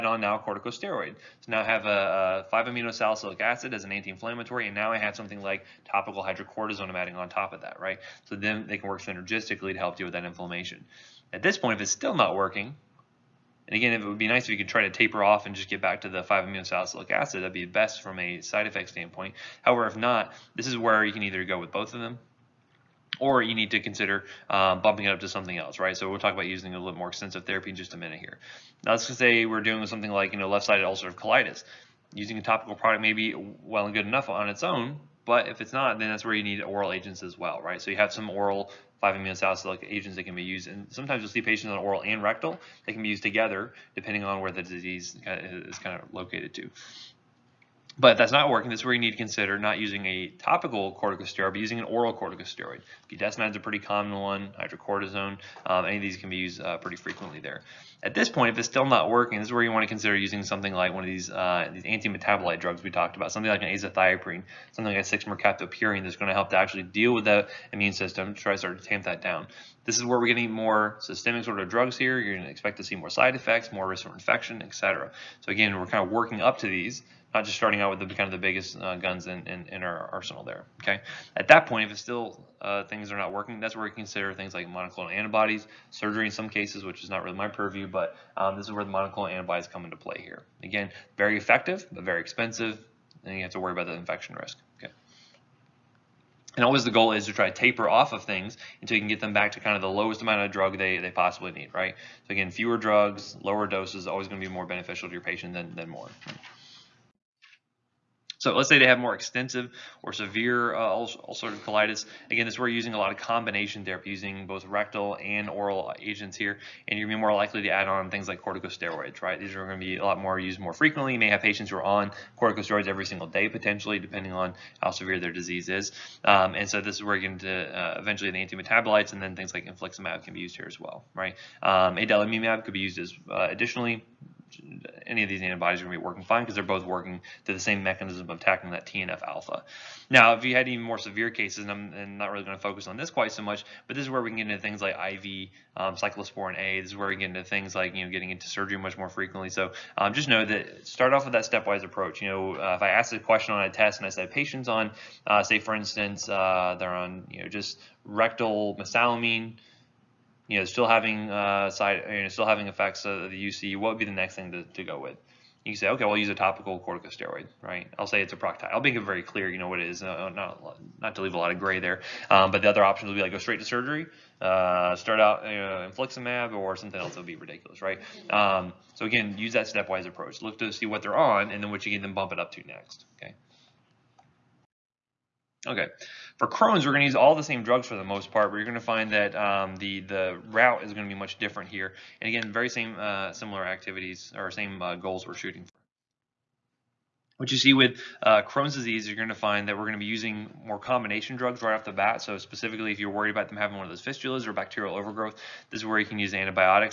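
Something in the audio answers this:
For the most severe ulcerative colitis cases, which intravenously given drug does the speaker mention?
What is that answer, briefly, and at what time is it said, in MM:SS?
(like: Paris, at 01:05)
Cyclosporin A, at 02:25.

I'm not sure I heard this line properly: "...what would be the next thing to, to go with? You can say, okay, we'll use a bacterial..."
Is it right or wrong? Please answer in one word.
wrong.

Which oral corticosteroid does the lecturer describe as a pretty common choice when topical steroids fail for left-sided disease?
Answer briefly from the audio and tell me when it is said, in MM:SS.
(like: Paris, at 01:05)
Budesonide, at 00:53.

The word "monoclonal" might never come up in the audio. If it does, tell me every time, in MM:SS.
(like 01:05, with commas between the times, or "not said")
01:24, 01:28.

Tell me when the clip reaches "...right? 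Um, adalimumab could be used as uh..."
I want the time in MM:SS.
02:11.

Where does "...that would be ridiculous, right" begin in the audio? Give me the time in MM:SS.
02:57.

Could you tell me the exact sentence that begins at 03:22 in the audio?
So specifically, if you're worried about them having one of those fistulas or bacterial overgrowth, this is where you can use antibiotics.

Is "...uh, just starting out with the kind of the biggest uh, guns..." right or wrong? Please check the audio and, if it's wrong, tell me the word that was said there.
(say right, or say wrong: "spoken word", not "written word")
right.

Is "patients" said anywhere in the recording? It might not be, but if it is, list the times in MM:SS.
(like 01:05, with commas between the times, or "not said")
00:41, 01:45, 02:01, 02:34.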